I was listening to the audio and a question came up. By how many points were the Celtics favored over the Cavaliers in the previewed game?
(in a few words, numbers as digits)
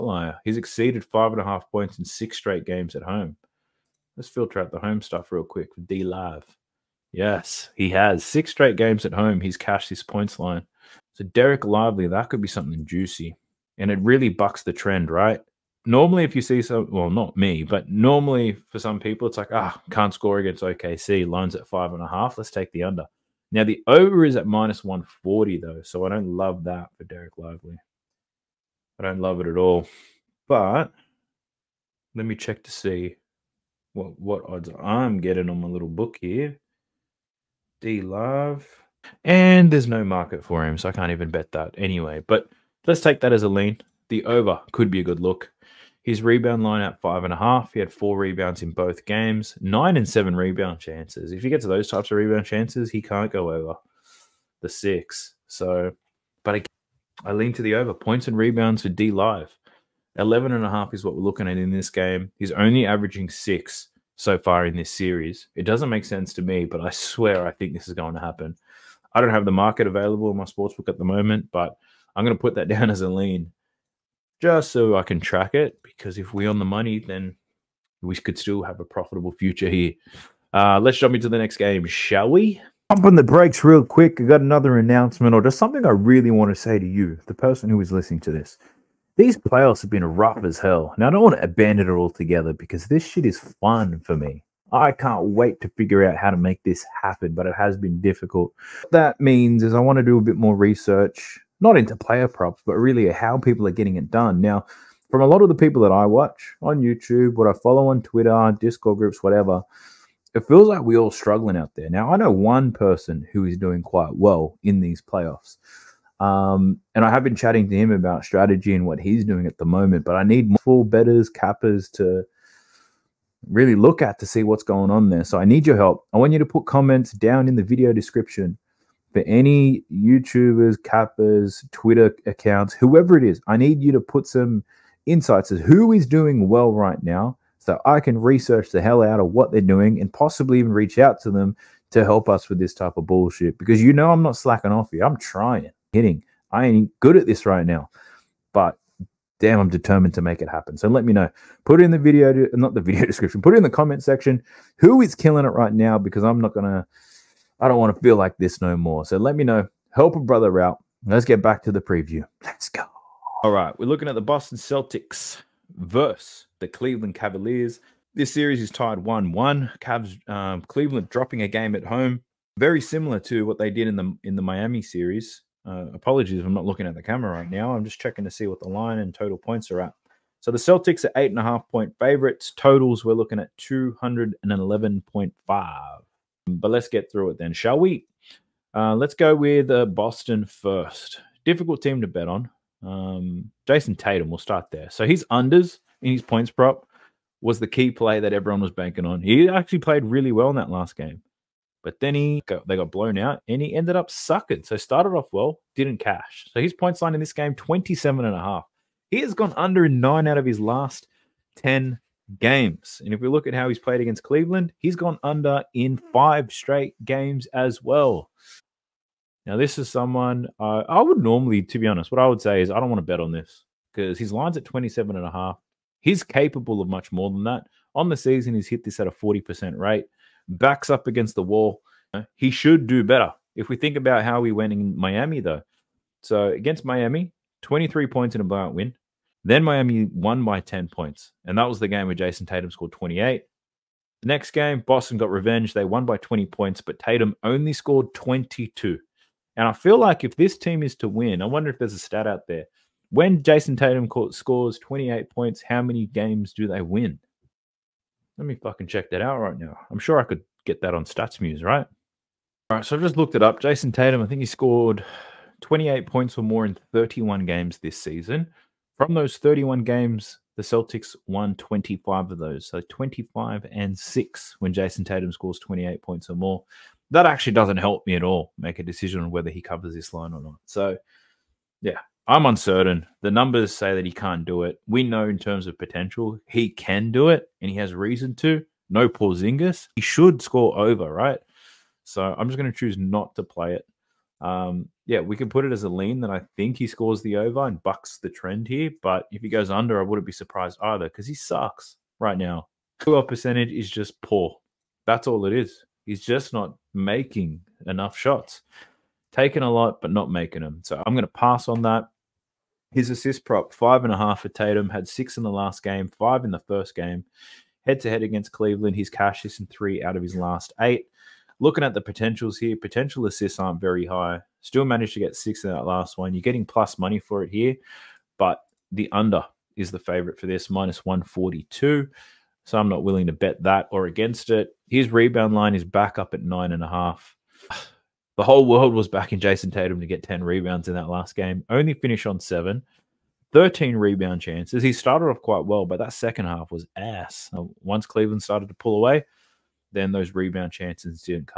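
8.5.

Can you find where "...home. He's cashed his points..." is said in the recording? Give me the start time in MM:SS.
00:09.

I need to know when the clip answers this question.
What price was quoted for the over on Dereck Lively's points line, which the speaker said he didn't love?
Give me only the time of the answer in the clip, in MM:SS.
00:24.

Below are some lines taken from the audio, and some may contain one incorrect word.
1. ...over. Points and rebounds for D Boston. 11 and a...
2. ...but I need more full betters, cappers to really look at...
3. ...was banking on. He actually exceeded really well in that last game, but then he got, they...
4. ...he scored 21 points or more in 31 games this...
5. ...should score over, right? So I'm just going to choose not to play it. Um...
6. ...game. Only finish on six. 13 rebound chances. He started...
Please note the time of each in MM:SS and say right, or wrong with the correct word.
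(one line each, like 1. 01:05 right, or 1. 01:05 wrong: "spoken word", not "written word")
1. 00:57 wrong: "Live", not "Boston"
2. 02:00 right
3. 03:18 wrong: "played", not "exceeded"
4. 04:24 wrong: "28", not "21"
5. 04:50 right
6. 05:41 wrong: "seven", not "six".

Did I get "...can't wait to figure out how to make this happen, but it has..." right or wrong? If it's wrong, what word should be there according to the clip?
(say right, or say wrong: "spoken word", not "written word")
right.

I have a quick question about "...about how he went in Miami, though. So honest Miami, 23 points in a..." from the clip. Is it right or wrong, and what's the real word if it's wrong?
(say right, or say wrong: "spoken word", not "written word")
wrong: "against", not "honest".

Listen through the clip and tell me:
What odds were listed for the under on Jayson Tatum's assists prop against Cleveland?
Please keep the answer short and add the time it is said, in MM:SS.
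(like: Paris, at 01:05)
-142, at 05:30.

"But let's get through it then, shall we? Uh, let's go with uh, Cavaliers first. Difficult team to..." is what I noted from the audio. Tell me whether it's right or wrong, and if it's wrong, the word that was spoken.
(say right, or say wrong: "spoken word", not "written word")
wrong: "Boston", not "Cavaliers".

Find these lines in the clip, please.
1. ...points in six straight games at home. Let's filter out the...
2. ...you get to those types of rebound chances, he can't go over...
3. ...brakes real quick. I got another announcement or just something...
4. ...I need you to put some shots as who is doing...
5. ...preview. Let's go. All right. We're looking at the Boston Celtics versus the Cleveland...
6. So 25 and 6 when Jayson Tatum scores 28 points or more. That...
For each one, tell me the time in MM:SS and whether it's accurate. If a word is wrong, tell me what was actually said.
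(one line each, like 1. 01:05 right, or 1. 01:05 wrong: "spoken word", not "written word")
1. 00:01 right
2. 00:51 right
3. 01:23 right
4. 02:13 wrong: "insights", not "shots"
5. 02:41 right
6. 04:32 right.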